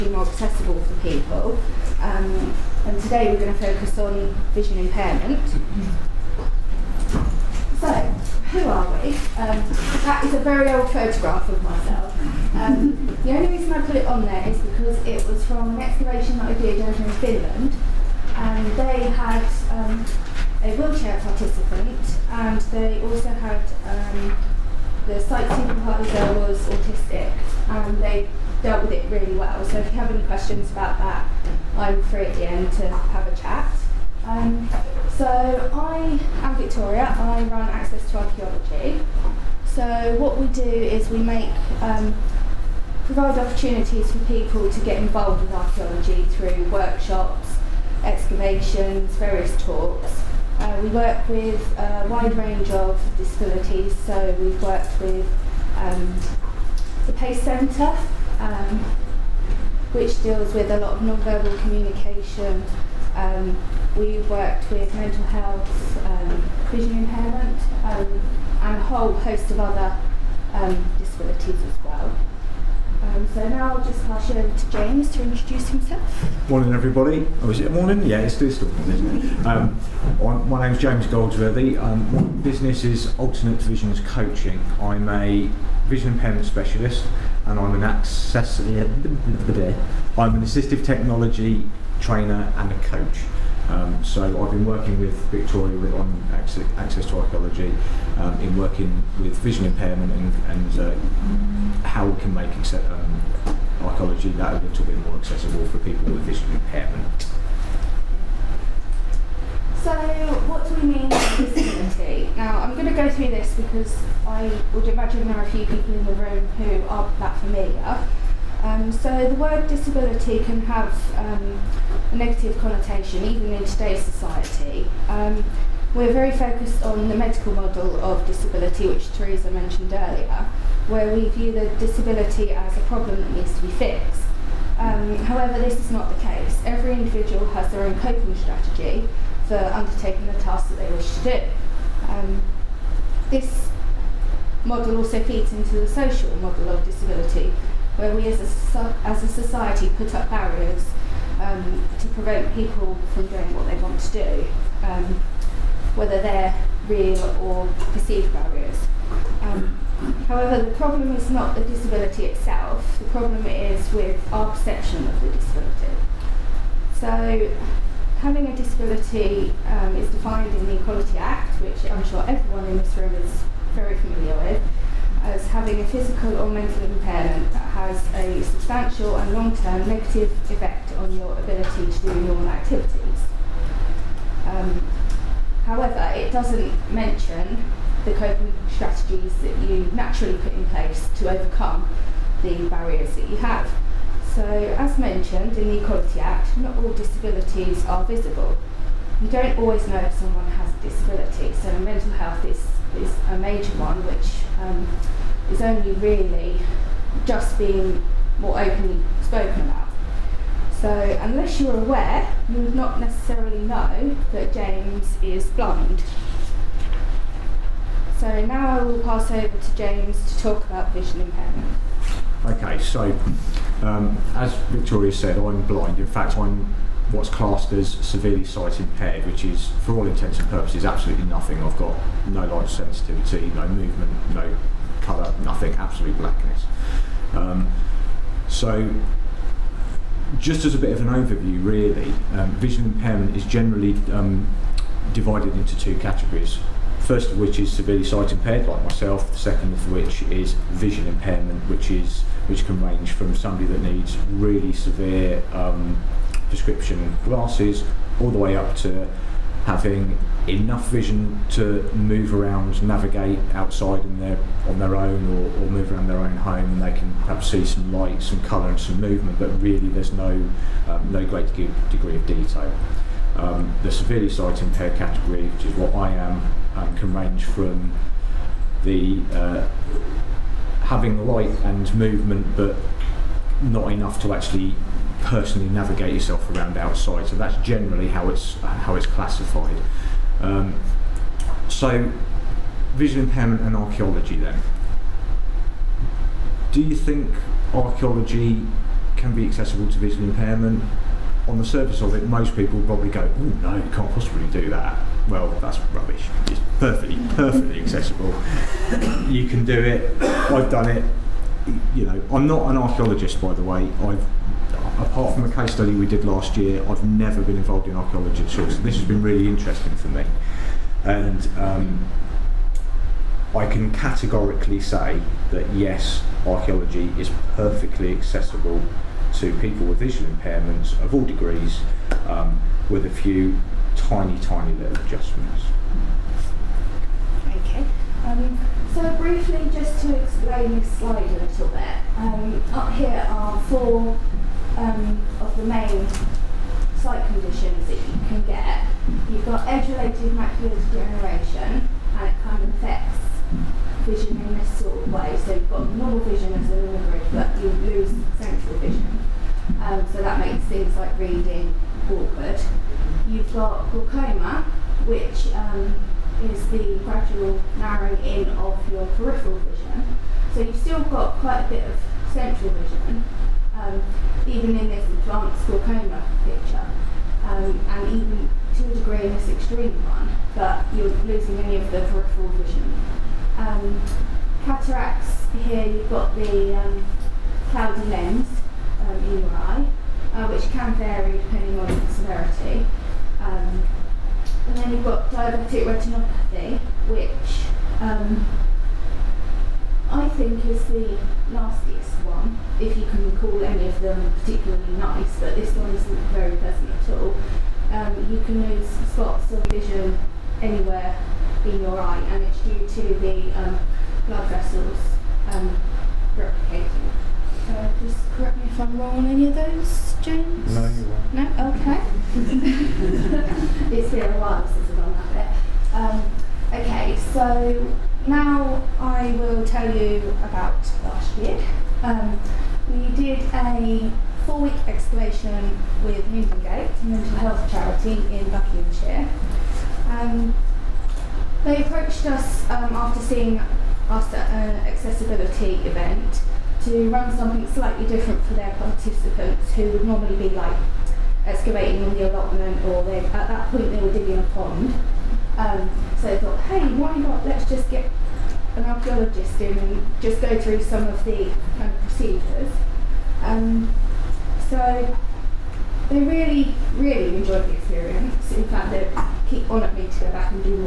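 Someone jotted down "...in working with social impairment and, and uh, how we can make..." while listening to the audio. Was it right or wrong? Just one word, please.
wrong.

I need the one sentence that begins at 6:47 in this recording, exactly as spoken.
Um, you can lose spots of vision anywhere in your eye, and it's due to the um, blood vessels um, replicating.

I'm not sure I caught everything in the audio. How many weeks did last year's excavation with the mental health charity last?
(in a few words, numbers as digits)
4.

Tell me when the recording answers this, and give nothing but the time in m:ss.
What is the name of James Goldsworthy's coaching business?
1:23.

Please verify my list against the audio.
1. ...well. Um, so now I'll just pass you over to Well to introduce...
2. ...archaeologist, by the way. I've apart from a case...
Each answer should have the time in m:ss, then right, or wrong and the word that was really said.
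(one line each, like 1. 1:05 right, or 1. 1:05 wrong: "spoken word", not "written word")
1. 1:11 wrong: "James", not "Well"
2. 5:12 right.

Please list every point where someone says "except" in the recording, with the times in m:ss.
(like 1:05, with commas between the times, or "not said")
not said.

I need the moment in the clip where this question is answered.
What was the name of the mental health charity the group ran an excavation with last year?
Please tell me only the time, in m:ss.
7:16.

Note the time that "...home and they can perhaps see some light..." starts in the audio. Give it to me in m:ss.
4:26.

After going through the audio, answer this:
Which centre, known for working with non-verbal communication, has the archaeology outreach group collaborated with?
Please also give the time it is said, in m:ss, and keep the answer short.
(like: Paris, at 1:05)
The PACE Centre, at 0:57.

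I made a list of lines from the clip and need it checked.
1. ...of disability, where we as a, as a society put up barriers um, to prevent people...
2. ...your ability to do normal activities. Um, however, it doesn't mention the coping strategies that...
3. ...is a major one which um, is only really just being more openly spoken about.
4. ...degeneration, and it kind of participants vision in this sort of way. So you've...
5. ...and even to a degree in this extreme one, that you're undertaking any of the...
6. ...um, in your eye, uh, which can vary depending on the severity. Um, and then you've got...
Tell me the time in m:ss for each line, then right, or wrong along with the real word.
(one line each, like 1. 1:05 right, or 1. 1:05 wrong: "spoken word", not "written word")
1. 2:26 right
2. 3:01 right
3. 3:22 right
4. 5:50 wrong: "affects", not "participants"
5. 6:17 wrong: "losing", not "undertaking"
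6. 6:29 right.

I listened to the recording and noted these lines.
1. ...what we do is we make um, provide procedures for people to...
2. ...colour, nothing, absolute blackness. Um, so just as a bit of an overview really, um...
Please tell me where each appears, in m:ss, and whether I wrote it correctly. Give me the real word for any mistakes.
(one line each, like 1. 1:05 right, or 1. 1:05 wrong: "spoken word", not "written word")
1. 0:40 wrong: "opportunities", not "procedures"
2. 3:55 right.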